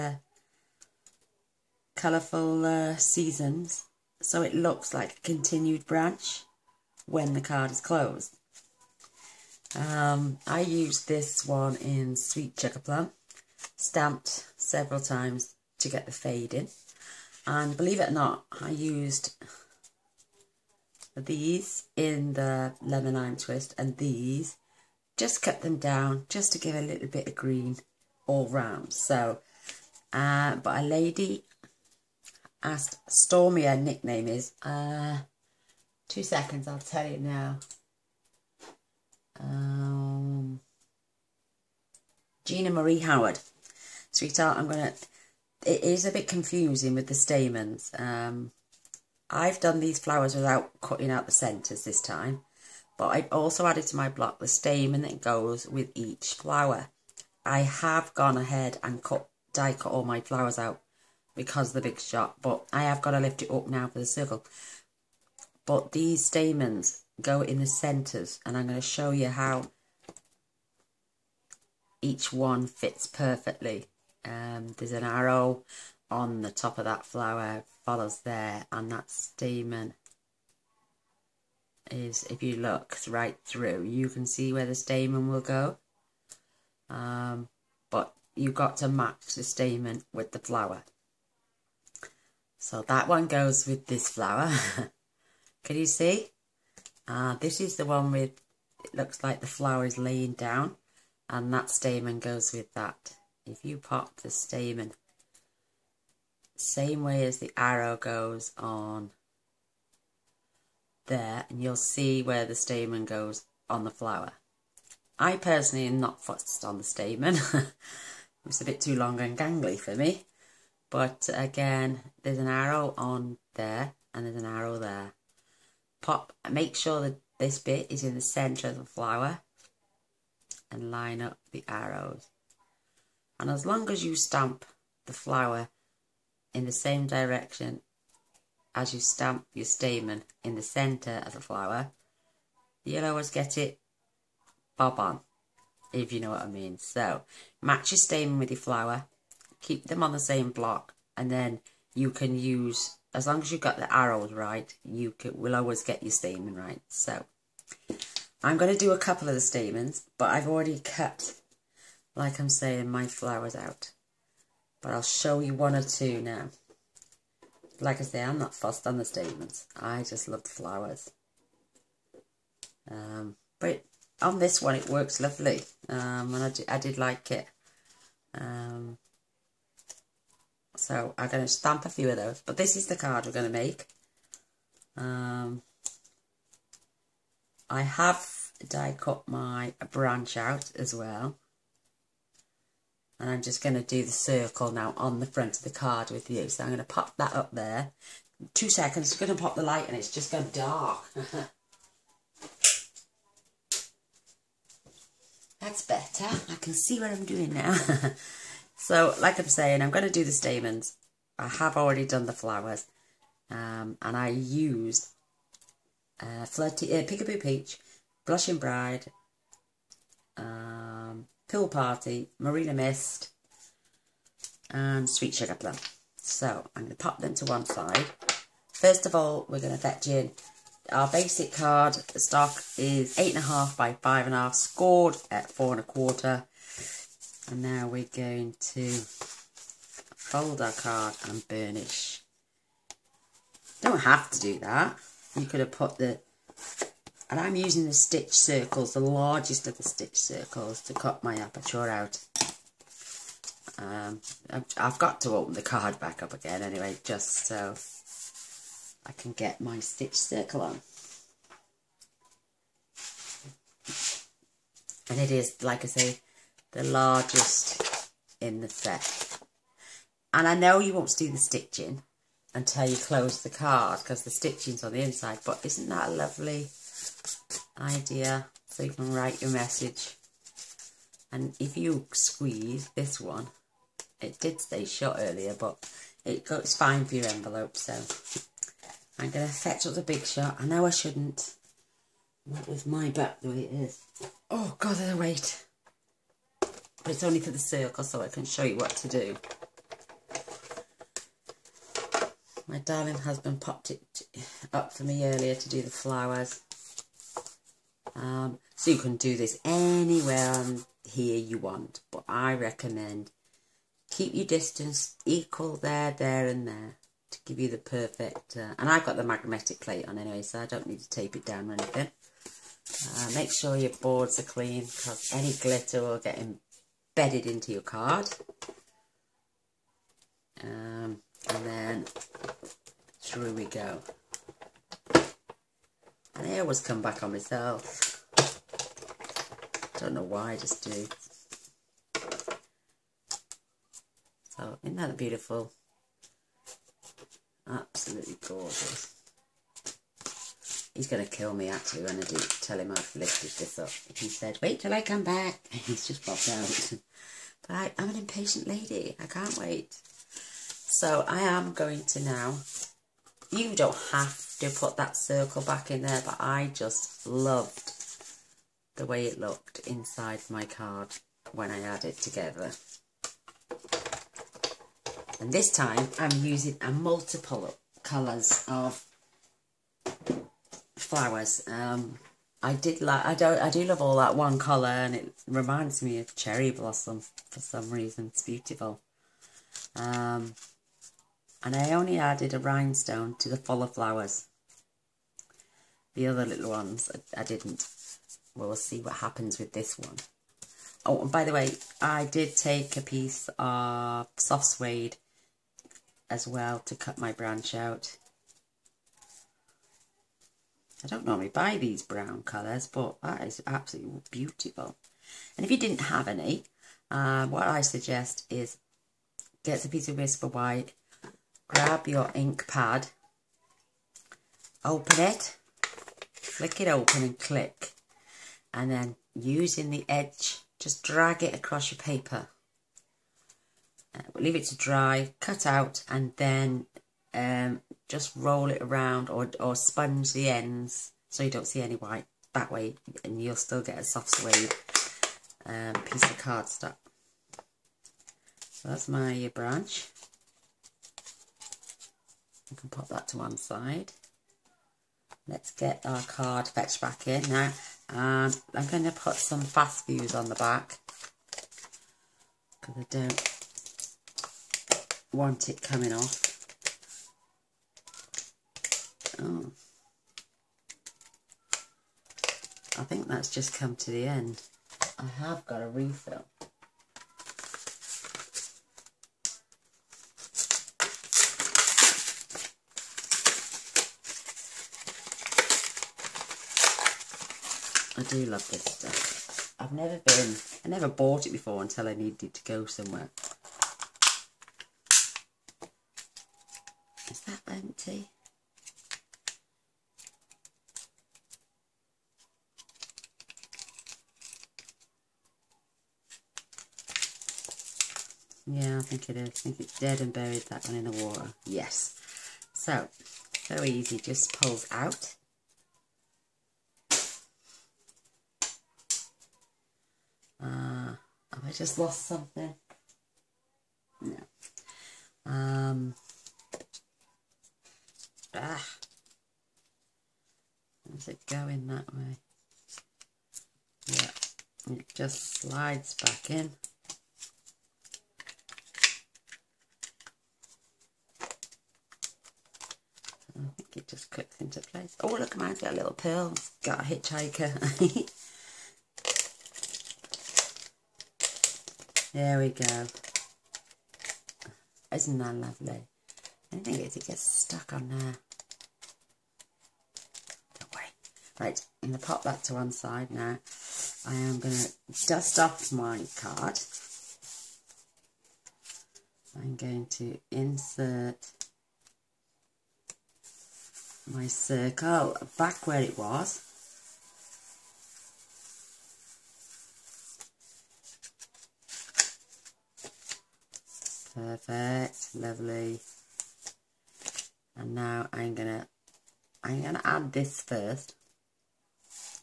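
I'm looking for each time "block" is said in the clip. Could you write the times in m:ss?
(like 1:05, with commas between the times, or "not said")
0:54, 2:30.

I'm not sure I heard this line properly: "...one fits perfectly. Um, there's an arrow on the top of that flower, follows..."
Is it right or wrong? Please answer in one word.
right.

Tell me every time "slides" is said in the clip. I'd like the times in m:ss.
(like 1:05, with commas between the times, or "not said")
8:55.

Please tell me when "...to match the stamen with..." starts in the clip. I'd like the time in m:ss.
1:28.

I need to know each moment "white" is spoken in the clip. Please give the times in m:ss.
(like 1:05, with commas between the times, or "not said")
7:00, 7:21.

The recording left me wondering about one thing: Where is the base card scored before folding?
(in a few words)
4 and a quarter.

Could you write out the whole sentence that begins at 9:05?
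Oh, look, mine's got a little pearl.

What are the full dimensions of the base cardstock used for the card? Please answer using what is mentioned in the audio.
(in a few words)
8.5 by 5.5.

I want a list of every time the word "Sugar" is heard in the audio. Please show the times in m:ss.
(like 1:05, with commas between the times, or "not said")
0:12, 3:45.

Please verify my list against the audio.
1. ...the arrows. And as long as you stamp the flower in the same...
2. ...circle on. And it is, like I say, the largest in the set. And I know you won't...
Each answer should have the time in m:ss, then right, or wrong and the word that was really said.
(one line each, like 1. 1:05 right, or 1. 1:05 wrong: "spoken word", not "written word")
1. 2:11 right
2. 4:20 right.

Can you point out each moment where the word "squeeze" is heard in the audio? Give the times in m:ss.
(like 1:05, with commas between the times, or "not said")
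4:42.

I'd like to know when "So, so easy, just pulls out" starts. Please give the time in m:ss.
8:32.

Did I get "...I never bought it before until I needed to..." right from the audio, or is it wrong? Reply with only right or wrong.
right.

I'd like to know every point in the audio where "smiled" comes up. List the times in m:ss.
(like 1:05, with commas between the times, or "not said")
not said.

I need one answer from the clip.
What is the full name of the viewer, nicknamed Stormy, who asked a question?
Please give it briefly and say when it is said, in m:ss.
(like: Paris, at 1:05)
Gina Marie Howard, at 0:42.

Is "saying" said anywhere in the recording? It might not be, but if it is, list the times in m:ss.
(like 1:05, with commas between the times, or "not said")
2:42, 3:29.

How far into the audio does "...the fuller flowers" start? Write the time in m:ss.
6:33.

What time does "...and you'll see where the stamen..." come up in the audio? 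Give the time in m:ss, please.
1:51.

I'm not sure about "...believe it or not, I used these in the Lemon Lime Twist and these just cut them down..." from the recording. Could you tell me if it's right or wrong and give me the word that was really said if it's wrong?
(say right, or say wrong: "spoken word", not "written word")
right.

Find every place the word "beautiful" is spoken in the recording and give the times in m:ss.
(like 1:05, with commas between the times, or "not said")
5:45, 6:28, 6:54.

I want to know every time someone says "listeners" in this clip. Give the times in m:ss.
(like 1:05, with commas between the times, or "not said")
not said.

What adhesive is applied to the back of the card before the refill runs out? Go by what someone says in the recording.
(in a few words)
Fast Fuse.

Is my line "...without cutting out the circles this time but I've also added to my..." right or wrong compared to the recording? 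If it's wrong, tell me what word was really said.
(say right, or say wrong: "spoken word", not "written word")
wrong: "centres", not "circles".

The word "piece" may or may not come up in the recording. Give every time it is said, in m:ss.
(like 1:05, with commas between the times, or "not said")
6:43, 6:59, 7:26.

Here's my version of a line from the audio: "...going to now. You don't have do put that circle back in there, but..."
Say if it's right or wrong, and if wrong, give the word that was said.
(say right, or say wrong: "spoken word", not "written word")
right.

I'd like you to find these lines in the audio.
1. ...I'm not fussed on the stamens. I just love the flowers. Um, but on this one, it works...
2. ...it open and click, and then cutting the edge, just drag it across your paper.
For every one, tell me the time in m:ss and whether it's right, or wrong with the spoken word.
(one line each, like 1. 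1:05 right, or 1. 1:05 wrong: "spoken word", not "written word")
1. 2:48 right
2. 7:06 wrong: "using", not "cutting".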